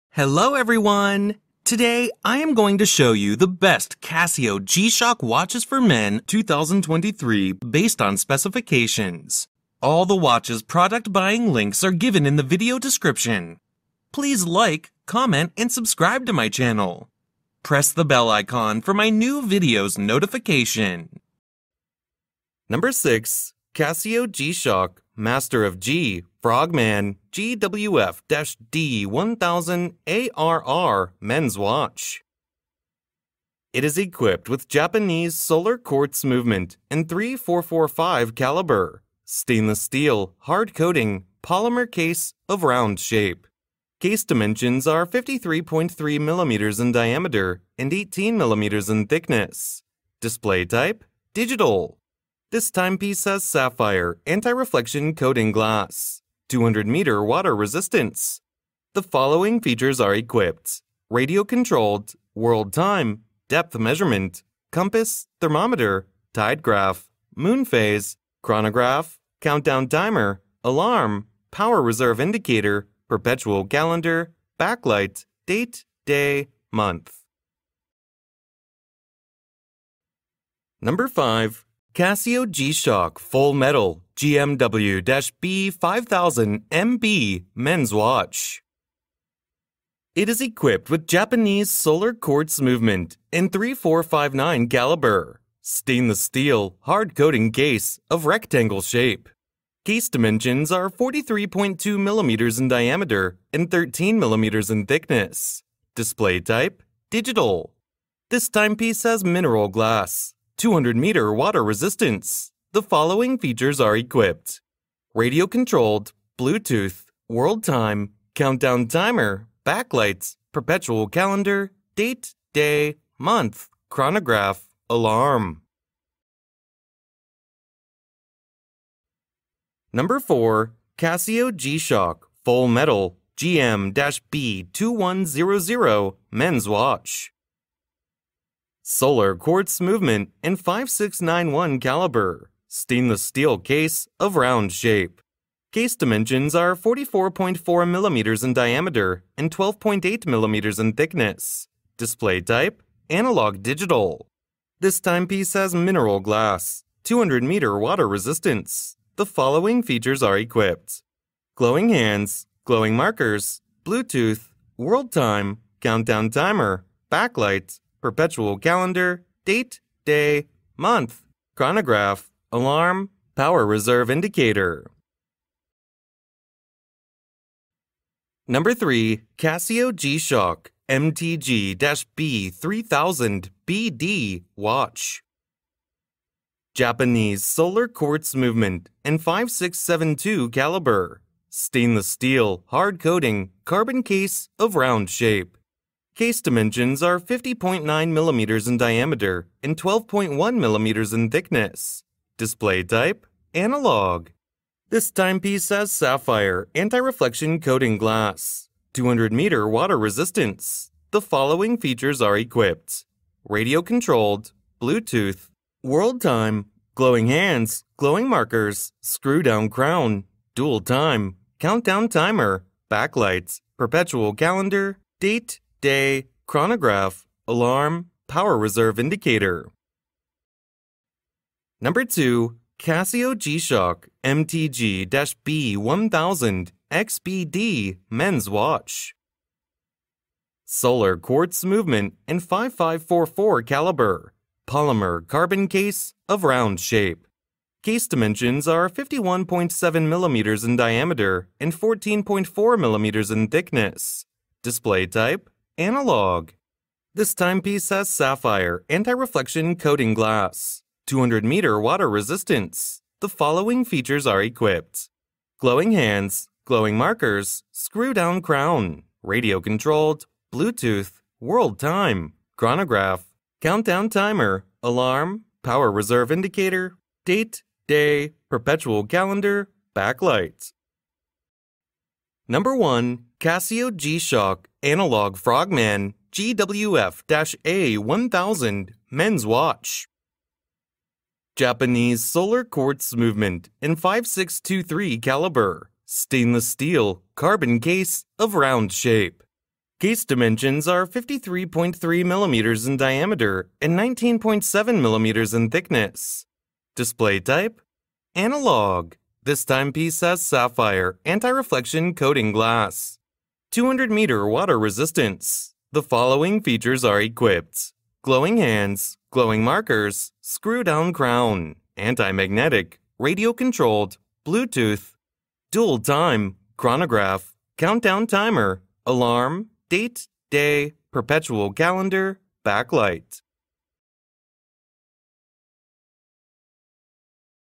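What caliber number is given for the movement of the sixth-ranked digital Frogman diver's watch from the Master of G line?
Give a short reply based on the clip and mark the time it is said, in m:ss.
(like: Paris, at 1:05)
3445, at 0:37.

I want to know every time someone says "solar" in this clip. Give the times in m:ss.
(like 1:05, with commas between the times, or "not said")
0:35, 1:31, 2:18, 3:07, 4:00, 4:52.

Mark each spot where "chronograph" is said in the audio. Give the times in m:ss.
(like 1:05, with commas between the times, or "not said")
1:08, 2:03, 2:51, 3:46, 4:32, 5:26.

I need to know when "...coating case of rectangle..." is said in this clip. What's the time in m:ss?
1:37.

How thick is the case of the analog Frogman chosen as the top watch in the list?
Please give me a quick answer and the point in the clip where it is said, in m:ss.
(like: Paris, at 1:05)
19.7 millimeters, at 5:03.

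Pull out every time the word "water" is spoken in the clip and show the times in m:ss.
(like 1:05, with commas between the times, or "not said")
0:57, 1:51, 2:37, 3:29, 4:21, 5:14.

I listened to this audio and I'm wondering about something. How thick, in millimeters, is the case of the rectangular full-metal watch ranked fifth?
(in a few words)
13 millimeters.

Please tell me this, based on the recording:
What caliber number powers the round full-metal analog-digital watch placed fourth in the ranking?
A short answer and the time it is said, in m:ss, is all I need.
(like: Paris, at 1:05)
5691, at 2:20.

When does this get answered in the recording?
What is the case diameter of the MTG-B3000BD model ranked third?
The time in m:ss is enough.
3:17.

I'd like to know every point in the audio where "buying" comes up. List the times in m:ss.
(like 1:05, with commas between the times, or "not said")
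0:11.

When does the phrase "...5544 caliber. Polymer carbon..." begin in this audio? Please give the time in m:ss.
4:02.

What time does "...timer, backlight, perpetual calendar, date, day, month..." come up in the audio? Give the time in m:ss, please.
2:46.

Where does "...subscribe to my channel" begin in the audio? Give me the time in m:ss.
0:15.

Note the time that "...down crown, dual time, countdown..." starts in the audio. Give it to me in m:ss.
3:39.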